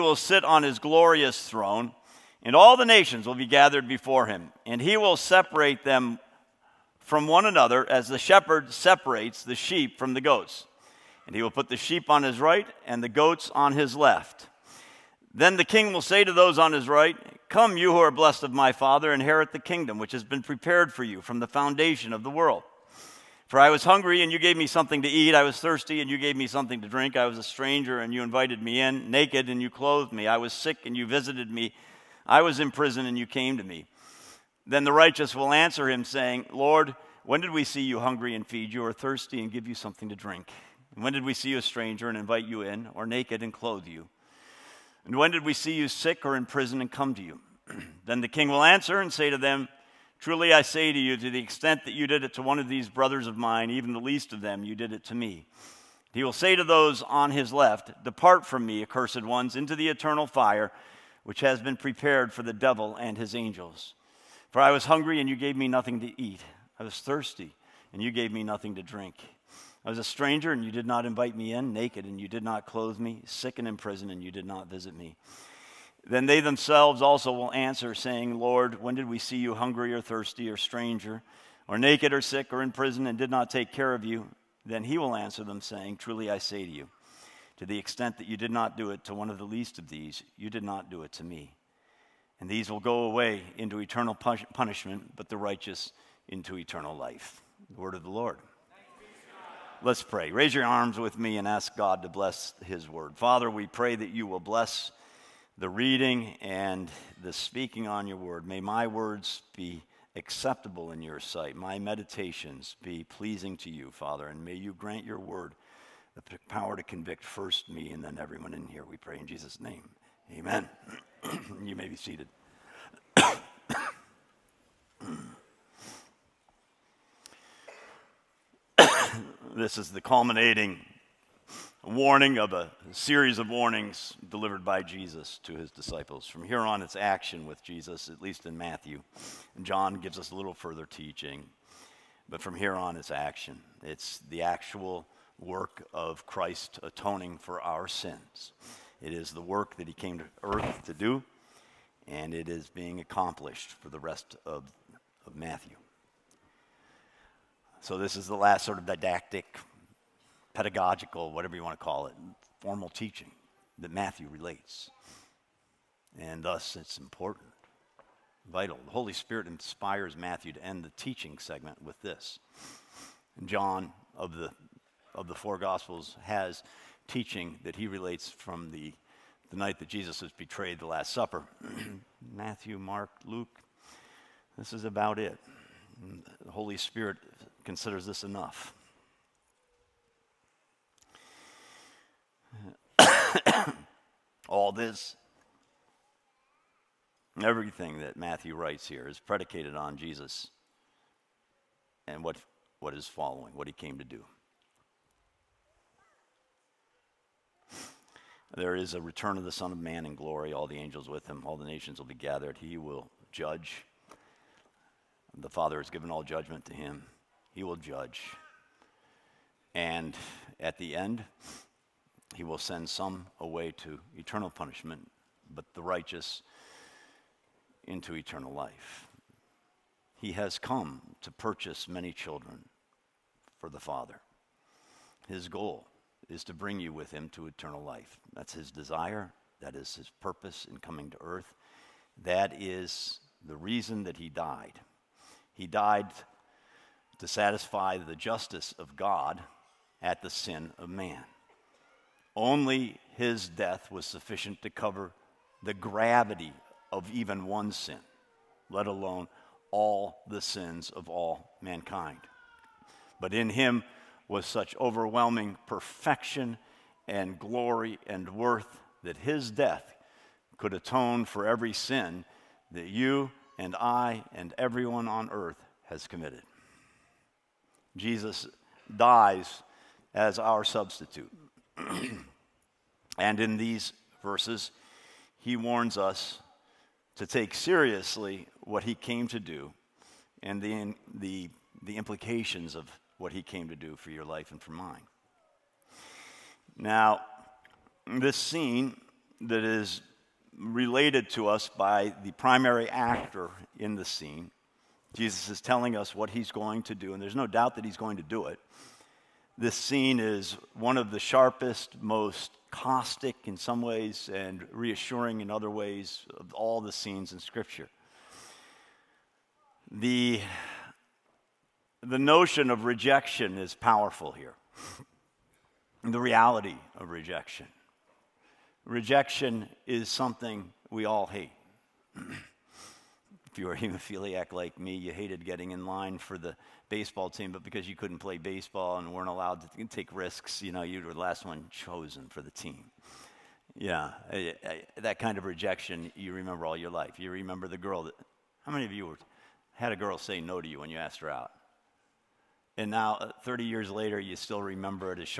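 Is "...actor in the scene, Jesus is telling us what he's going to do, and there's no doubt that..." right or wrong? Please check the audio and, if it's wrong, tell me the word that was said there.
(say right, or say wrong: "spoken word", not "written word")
right.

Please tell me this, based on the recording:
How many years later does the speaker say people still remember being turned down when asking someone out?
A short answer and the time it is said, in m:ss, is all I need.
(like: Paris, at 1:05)
30, at 5:53.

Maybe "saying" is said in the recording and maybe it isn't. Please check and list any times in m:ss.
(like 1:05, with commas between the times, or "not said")
0:36, 1:17, 1:25.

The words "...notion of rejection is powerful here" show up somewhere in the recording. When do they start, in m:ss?
5:22.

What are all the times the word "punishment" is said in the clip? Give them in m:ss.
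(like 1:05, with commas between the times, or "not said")
1:34, 3:44.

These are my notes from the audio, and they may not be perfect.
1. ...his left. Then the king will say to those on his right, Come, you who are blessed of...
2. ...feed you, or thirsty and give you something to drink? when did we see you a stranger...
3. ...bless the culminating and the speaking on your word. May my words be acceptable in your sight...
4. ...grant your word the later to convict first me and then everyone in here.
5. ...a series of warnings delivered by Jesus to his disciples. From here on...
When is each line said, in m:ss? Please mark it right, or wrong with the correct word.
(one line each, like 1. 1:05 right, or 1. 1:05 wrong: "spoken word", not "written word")
1. 0:13 right
2. 0:38 right
3. 1:44 wrong: "reading", not "culminating"
4. 1:54 wrong: "power", not "later"
5. 2:12 right.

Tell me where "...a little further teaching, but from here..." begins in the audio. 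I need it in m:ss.
2:20.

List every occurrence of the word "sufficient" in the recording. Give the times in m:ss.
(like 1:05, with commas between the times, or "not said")
4:14.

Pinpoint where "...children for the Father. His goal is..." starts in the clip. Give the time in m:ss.
3:52.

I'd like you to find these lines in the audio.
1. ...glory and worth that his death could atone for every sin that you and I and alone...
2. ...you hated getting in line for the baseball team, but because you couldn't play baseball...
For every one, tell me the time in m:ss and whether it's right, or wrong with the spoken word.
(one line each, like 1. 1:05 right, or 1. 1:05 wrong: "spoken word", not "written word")
1. 4:27 wrong: "everyone", not "alone"
2. 5:34 right.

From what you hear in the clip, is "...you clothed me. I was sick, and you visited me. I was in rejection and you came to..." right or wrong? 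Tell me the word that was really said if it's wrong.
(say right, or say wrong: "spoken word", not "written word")
wrong: "prison", not "rejection".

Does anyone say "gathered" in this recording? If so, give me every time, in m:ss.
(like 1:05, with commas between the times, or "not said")
0:03, 3:32.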